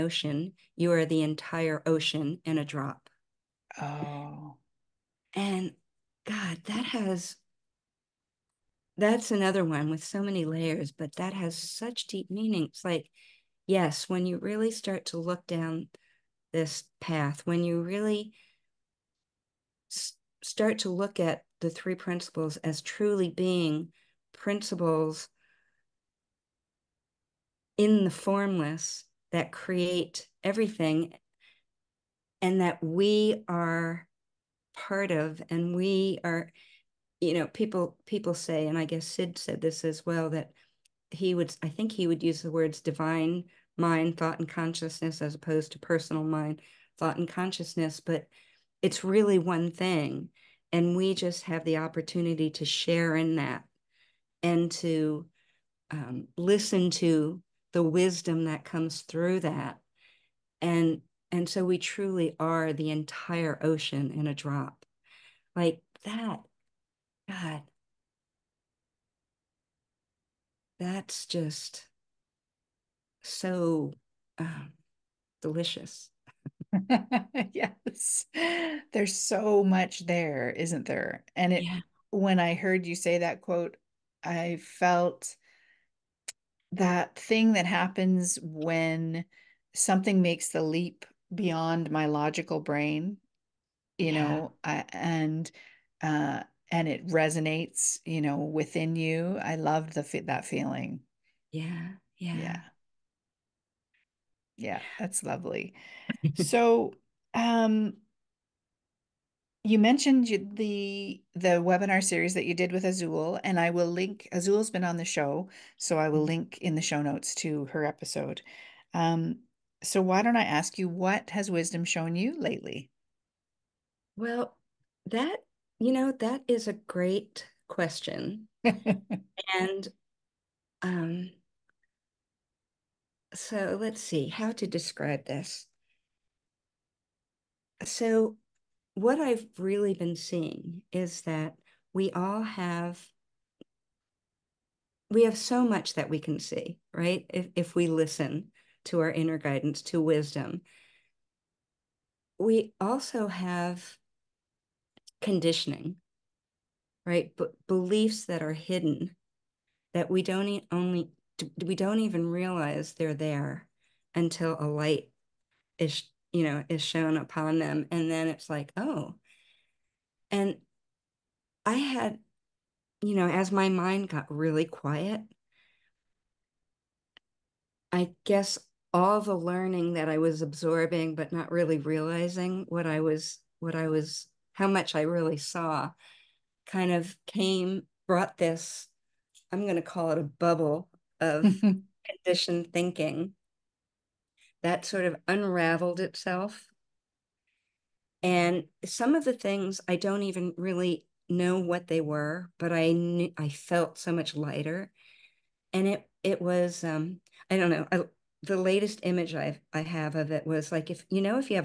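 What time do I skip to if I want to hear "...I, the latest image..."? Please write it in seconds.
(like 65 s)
207 s.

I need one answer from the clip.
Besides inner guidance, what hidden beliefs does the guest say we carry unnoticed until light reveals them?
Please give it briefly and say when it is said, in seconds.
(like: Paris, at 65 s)
Conditioning, at 155 s.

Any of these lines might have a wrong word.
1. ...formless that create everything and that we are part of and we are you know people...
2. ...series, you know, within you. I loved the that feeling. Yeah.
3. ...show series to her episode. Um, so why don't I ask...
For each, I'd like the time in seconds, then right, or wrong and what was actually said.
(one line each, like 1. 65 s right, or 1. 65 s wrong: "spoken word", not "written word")
1. 28 s right
2. 97 s wrong: "resonates", not "series"
3. 116 s wrong: "notes", not "series".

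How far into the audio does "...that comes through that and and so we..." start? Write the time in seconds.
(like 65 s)
58 s.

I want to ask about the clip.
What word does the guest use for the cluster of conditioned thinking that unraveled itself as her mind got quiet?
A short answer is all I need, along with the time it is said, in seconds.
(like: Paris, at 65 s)
Bubble, at 190 s.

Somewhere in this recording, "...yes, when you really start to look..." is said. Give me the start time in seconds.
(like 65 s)
13 s.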